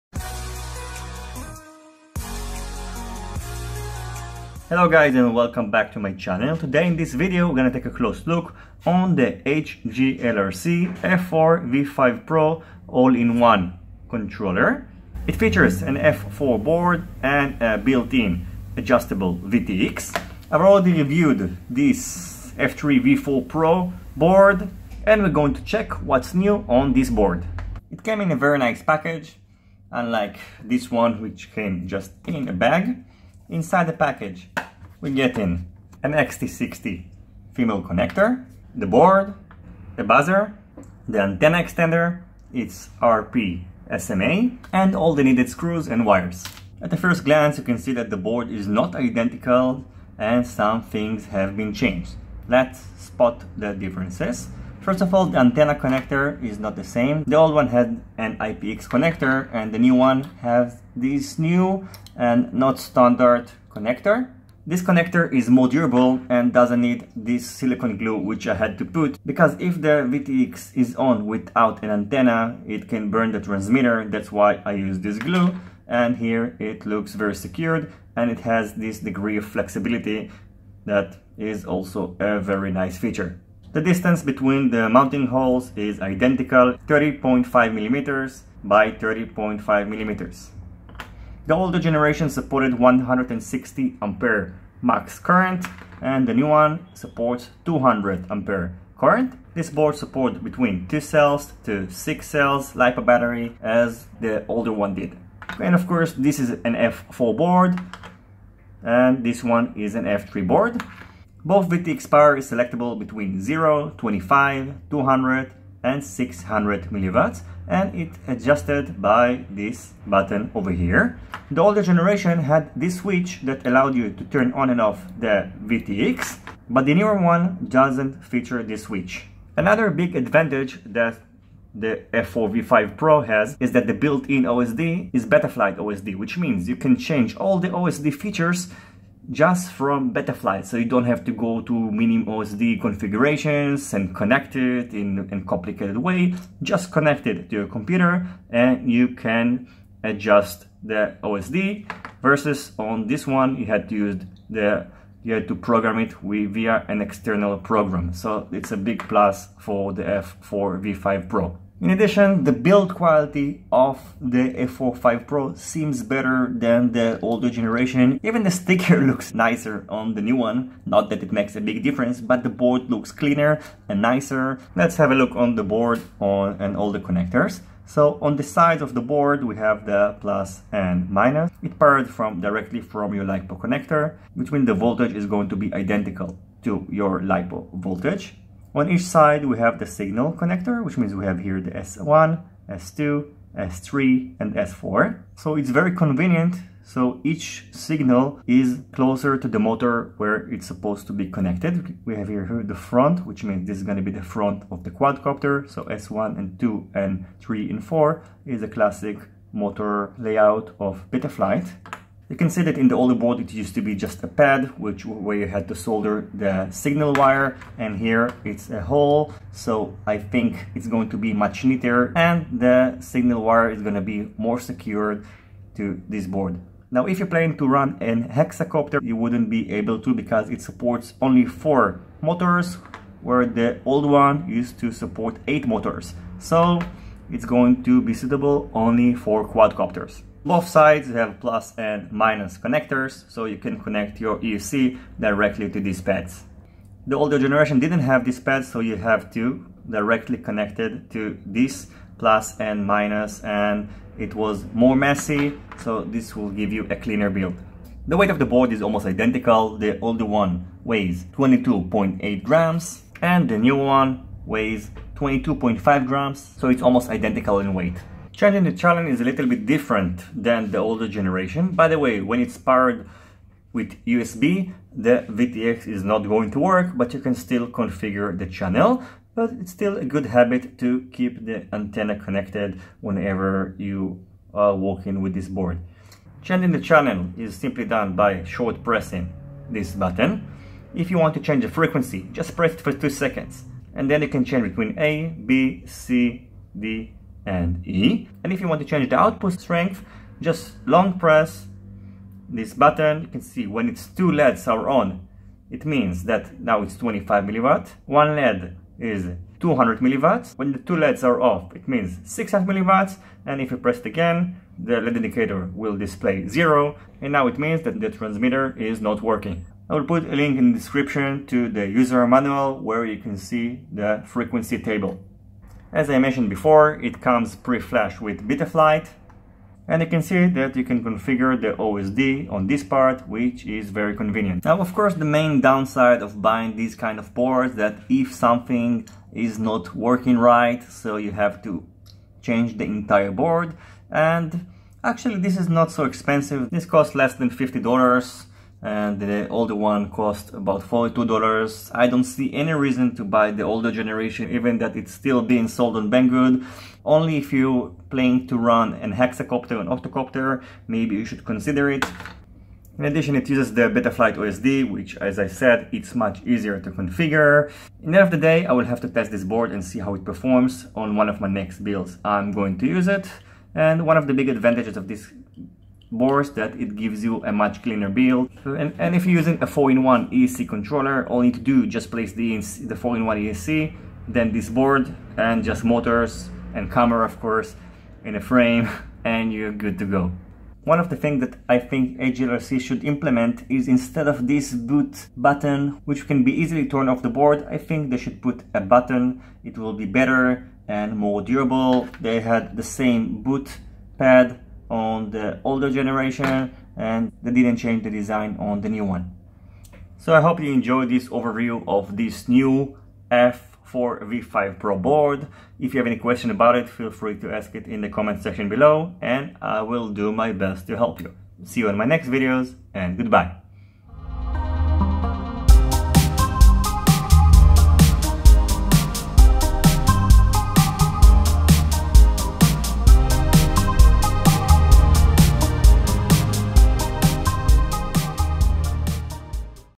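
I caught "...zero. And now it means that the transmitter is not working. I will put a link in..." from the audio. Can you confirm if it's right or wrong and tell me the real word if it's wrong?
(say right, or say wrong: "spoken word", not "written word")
right.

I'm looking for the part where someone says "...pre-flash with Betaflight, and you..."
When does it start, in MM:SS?
05:27.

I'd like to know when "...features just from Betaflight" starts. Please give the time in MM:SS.
02:18.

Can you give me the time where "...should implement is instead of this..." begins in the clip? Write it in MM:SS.
06:32.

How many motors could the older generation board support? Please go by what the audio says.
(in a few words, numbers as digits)
8.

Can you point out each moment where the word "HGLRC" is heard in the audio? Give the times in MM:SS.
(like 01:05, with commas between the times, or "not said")
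00:09, 06:32.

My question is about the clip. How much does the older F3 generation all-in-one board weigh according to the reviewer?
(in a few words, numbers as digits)
22.8 grams.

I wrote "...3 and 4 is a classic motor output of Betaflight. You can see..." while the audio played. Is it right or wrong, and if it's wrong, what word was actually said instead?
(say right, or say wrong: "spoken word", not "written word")
wrong: "layout", not "output".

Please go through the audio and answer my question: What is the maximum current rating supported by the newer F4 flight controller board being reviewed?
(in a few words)
200 amps.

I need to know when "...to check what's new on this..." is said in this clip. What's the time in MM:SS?
00:25.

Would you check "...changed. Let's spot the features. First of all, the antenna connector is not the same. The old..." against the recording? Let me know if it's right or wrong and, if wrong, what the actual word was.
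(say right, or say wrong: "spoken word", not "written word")
wrong: "differences", not "features".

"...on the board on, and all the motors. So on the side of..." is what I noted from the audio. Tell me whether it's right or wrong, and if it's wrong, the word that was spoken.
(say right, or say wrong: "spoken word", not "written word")
wrong: "connectors", not "motors".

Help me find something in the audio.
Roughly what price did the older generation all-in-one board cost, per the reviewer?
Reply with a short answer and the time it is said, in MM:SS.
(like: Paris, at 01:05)
$42, at 05:50.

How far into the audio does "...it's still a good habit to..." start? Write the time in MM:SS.
04:39.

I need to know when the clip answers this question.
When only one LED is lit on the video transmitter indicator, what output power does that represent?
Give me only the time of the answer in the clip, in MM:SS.
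05:09.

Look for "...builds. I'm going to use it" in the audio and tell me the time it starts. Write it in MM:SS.
06:11.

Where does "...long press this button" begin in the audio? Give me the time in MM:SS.
05:00.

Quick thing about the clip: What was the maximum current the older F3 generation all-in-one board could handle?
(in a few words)
160 amps.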